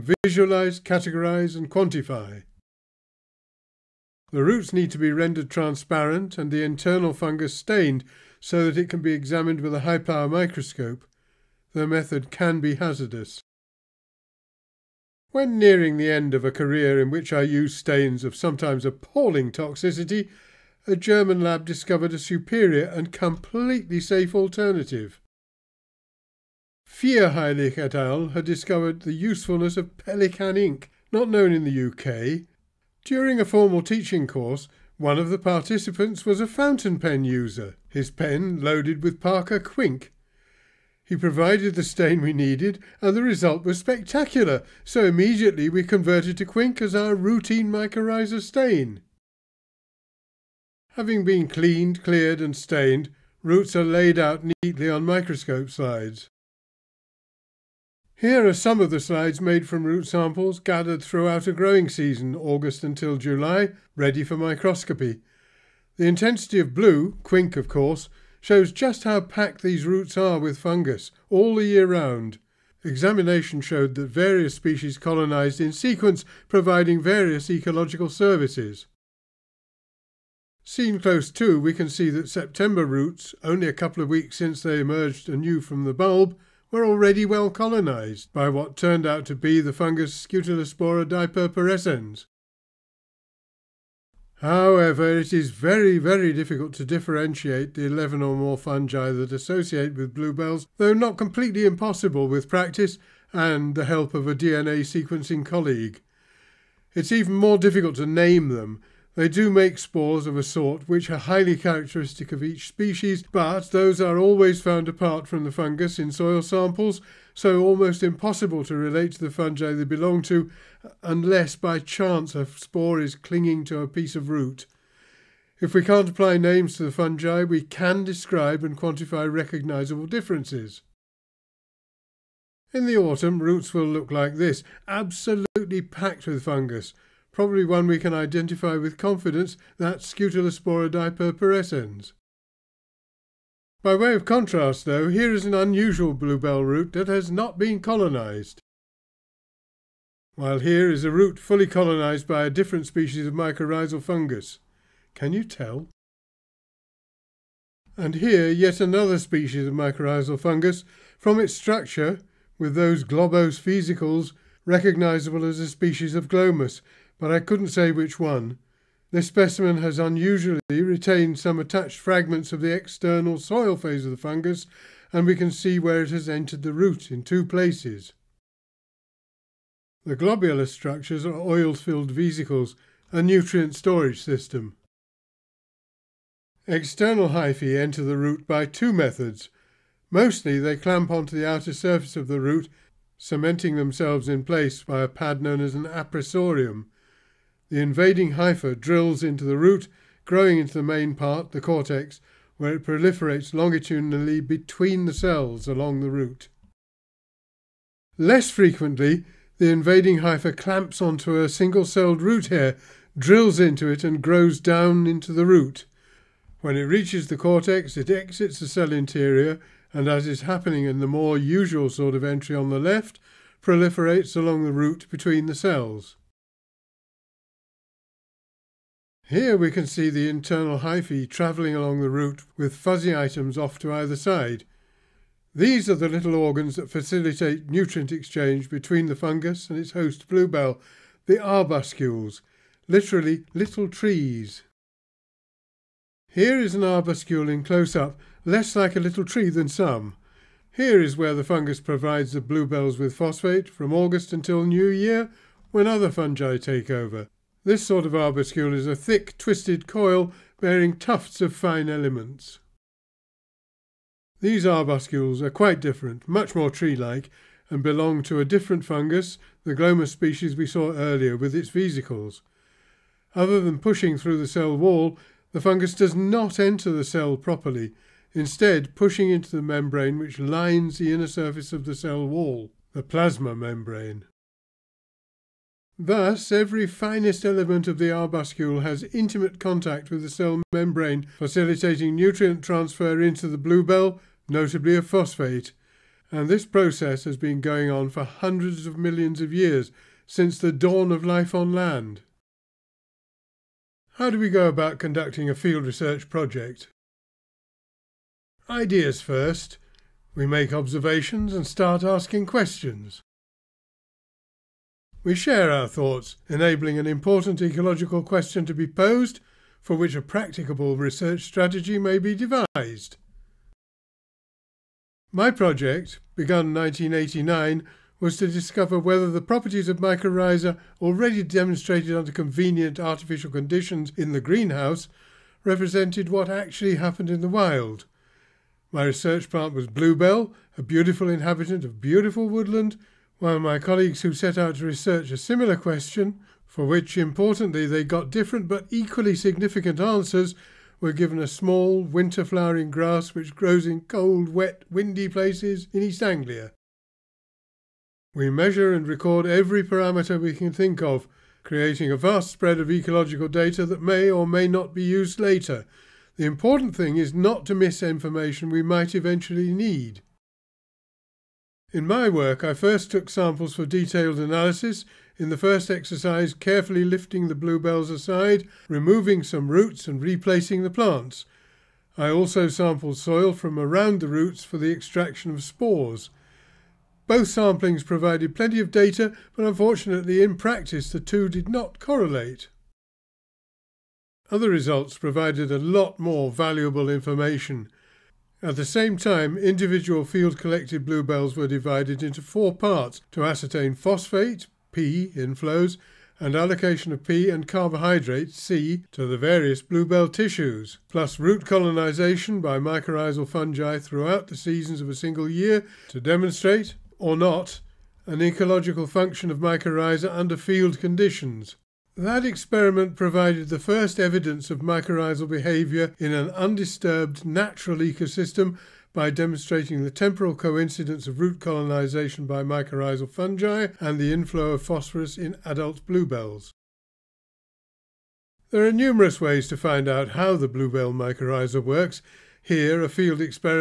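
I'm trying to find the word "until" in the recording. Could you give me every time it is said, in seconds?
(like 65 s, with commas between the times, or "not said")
62 s, 254 s.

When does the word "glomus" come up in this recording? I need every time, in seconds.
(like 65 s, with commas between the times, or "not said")
166 s, 269 s.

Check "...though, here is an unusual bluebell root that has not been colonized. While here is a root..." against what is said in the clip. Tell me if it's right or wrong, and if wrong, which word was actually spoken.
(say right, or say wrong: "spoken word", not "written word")
right.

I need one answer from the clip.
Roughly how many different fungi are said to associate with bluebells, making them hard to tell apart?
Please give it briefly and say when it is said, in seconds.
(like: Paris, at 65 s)
11 or more, at 97 s.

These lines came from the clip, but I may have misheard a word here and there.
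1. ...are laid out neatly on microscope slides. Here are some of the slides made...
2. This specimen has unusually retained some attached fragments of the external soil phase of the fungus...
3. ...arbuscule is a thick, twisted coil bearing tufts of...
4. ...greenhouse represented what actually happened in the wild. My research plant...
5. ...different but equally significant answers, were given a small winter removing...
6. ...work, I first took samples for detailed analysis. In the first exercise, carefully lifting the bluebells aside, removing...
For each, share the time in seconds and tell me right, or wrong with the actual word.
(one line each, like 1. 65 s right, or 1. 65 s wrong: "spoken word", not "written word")
1. 53 s right
2. 169 s right
3. 258 s right
4. 334 s right
5. 348 s wrong: "flowering", not "removing"
6. 372 s right.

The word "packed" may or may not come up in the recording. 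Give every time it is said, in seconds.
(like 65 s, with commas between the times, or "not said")
69 s, 135 s.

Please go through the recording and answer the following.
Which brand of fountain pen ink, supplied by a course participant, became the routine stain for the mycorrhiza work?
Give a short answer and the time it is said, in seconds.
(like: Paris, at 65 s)
Parker Quink, at 39 s.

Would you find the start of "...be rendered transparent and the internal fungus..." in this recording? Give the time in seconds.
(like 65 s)
4 s.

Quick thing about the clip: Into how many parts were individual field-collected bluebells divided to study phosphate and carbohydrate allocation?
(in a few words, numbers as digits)
4.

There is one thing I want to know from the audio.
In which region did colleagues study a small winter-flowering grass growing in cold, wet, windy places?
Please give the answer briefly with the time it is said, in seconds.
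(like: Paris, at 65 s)
East Anglia, at 356 s.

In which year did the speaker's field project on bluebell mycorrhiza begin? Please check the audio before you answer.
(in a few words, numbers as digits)
1989.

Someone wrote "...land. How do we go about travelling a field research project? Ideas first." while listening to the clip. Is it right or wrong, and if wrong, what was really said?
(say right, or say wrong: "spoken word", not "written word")
wrong: "conducting", not "travelling".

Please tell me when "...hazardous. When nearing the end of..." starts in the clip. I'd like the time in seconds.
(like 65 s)
12 s.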